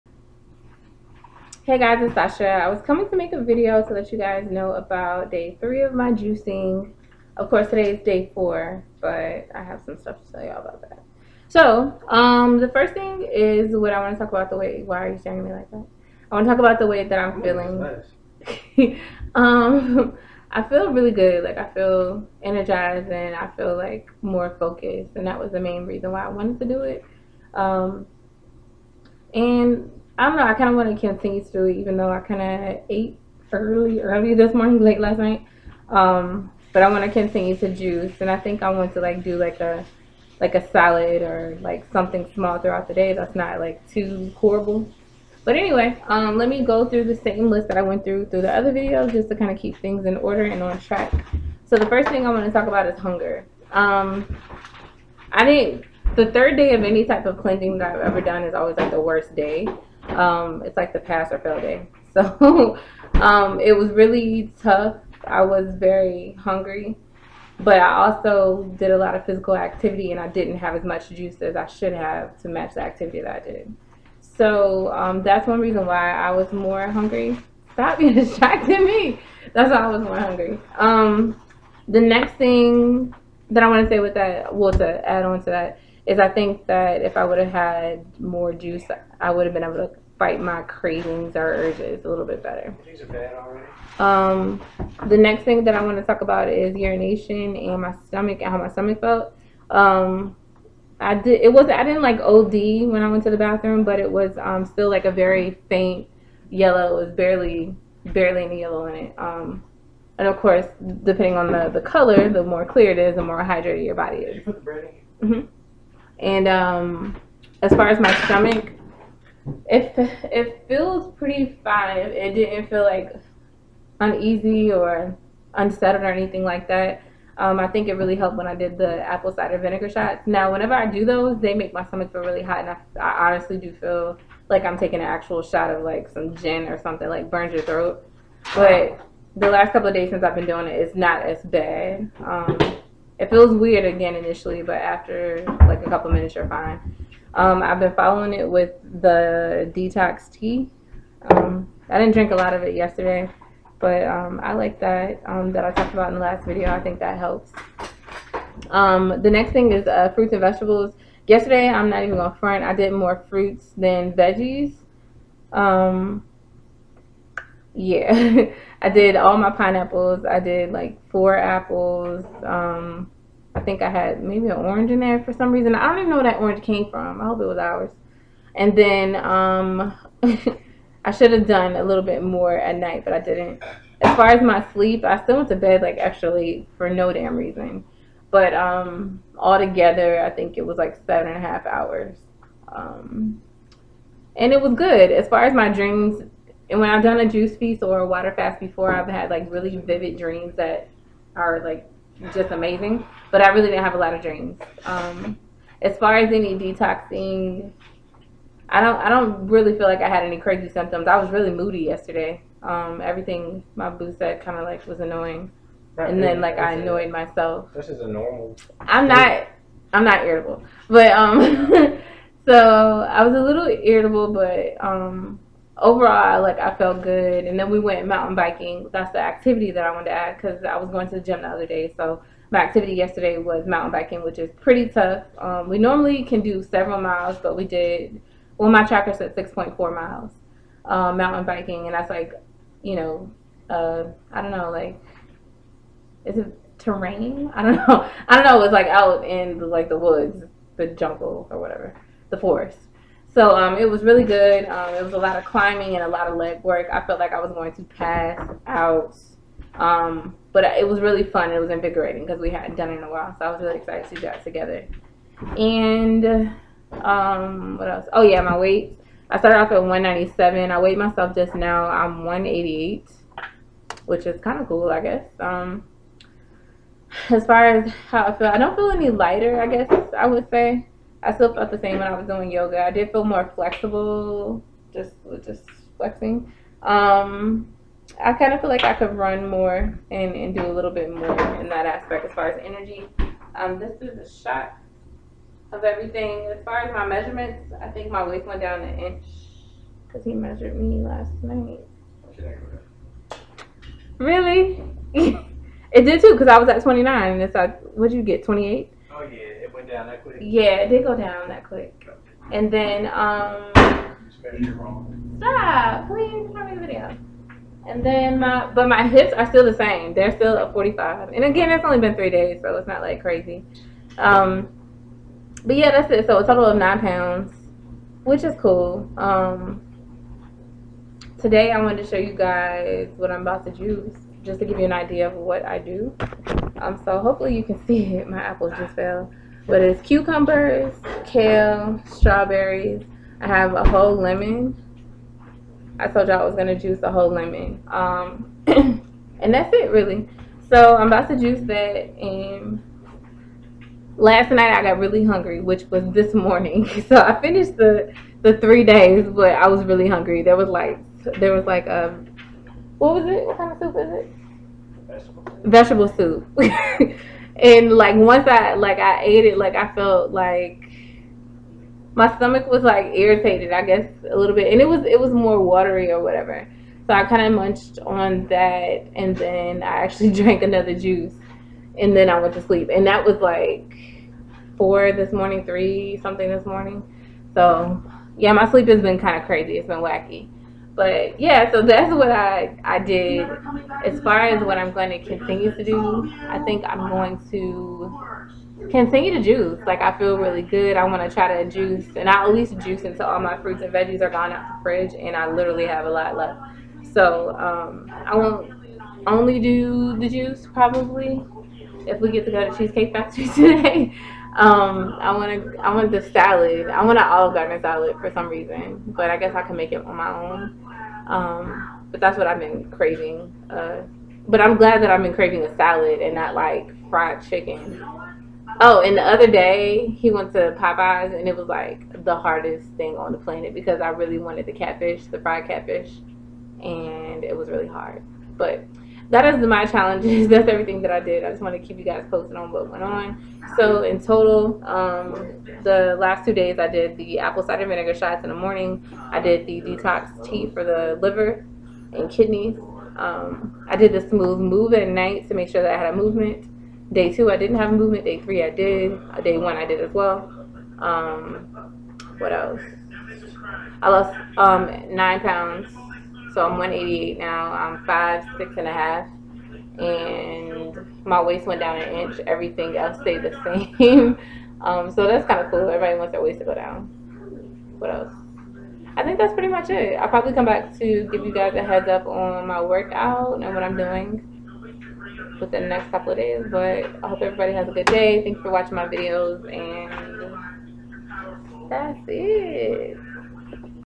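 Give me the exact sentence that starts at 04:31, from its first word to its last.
I'm 188, which is kind of cool, I guess.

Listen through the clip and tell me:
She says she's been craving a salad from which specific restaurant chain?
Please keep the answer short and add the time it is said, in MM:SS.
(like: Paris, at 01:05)
Olive Garden, at 06:57.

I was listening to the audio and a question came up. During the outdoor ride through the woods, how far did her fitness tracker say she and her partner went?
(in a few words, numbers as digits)
6.4 miles.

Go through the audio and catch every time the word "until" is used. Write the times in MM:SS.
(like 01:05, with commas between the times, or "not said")
06:43.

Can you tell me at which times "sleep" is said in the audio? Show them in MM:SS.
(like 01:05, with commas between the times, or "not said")
03:04, 06:22, 06:28.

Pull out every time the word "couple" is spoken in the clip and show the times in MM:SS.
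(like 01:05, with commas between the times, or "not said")
02:19, 02:25, 08:06.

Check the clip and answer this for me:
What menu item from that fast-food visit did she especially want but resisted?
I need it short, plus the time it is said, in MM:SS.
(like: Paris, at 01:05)
Fried catfish, at 07:15.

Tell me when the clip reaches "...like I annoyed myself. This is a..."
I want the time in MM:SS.
03:36.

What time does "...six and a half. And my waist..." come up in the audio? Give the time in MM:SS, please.
07:48.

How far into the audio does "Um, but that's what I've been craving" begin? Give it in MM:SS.
07:01.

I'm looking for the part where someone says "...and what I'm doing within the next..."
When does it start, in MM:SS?
08:03.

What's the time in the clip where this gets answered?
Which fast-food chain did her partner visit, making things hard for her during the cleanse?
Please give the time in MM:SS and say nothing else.
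07:10.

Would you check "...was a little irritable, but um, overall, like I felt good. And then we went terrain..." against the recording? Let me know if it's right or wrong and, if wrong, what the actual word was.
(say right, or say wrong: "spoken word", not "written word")
wrong: "mountain", not "terrain".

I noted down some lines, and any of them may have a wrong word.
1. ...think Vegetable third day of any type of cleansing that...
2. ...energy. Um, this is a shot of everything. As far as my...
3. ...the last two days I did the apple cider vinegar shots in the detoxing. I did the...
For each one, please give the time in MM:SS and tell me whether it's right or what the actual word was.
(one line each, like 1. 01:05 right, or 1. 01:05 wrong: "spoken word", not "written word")
1. 00:55 wrong: "The", not "Vegetable"
2. 04:52 right
3. 07:25 wrong: "morning", not "detoxing".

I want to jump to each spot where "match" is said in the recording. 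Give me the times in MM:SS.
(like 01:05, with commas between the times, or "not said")
01:12.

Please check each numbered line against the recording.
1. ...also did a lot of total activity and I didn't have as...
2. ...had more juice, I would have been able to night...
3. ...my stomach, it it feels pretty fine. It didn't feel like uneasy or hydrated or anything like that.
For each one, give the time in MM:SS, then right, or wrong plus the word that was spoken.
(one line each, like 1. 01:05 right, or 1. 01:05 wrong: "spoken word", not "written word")
1. 01:08 wrong: "physical", not "total"
2. 01:27 wrong: "fight", not "night"
3. 01:57 wrong: "unsettled", not "hydrated".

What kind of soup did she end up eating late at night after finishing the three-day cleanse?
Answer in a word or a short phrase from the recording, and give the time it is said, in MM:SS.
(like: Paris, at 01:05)
Vegetable soup, at 06:05.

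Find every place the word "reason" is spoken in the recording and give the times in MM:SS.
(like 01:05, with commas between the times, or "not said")
00:25, 01:15, 02:55, 03:07, 06:58.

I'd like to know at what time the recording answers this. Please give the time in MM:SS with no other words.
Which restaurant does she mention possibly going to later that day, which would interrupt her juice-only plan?
06:52.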